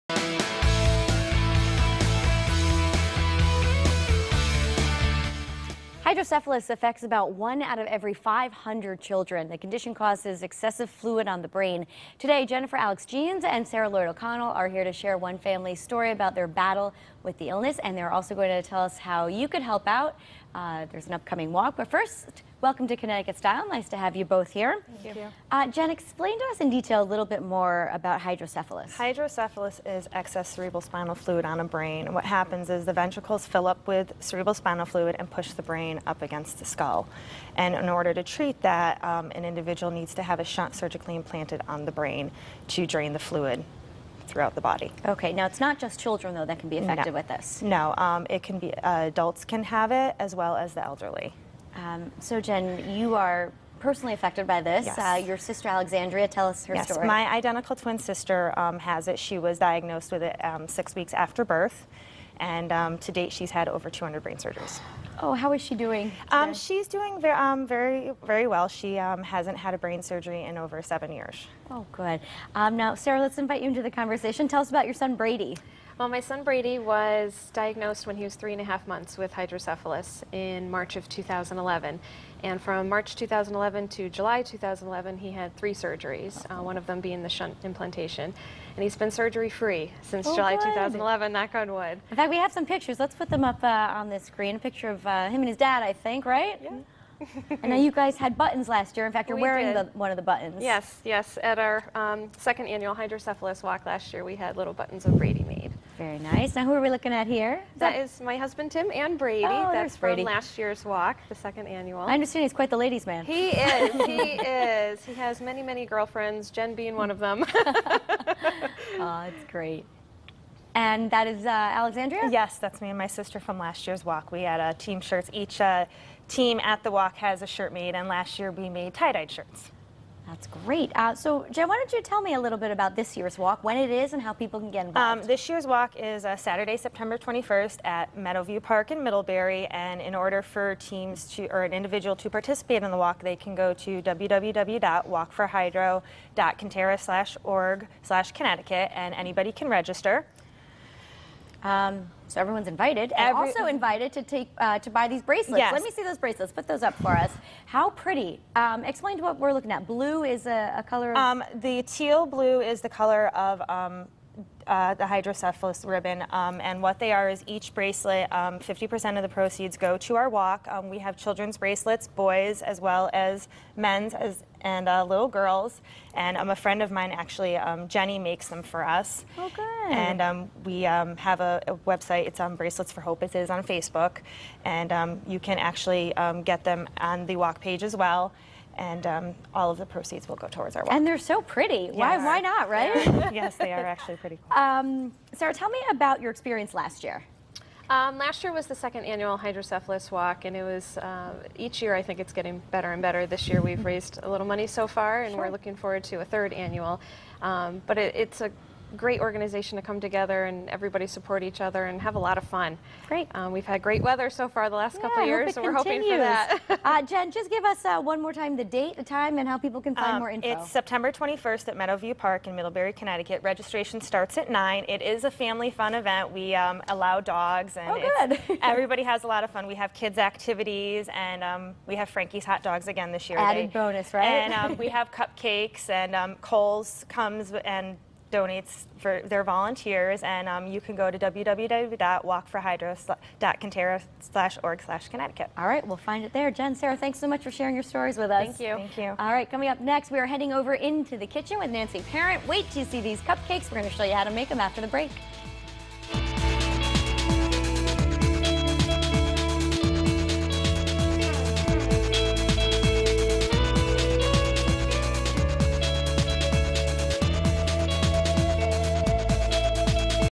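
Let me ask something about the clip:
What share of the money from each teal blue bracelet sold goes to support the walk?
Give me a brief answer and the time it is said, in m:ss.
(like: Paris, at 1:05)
50%, at 2:48.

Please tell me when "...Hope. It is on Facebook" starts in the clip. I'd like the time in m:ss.
3:03.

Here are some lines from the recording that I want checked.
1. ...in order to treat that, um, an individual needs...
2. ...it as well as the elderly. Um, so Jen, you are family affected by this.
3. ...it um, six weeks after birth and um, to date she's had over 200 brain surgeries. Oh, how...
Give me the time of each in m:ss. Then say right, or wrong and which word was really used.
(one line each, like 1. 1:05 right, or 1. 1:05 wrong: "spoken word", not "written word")
1. 0:37 right
2. 0:49 wrong: "personally", not "family"
3. 1:00 right.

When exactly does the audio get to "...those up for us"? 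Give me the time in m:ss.
2:36.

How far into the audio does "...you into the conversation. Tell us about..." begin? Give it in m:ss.
1:13.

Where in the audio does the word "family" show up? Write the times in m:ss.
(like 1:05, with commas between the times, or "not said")
0:15, 3:45.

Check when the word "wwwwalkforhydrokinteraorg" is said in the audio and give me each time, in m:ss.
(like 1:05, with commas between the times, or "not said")
2:24, 4:01.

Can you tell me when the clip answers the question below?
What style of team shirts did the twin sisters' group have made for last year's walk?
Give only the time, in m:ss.
2:08.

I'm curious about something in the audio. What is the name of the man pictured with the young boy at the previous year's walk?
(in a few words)
Tim.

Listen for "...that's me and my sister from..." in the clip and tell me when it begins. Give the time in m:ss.
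2:02.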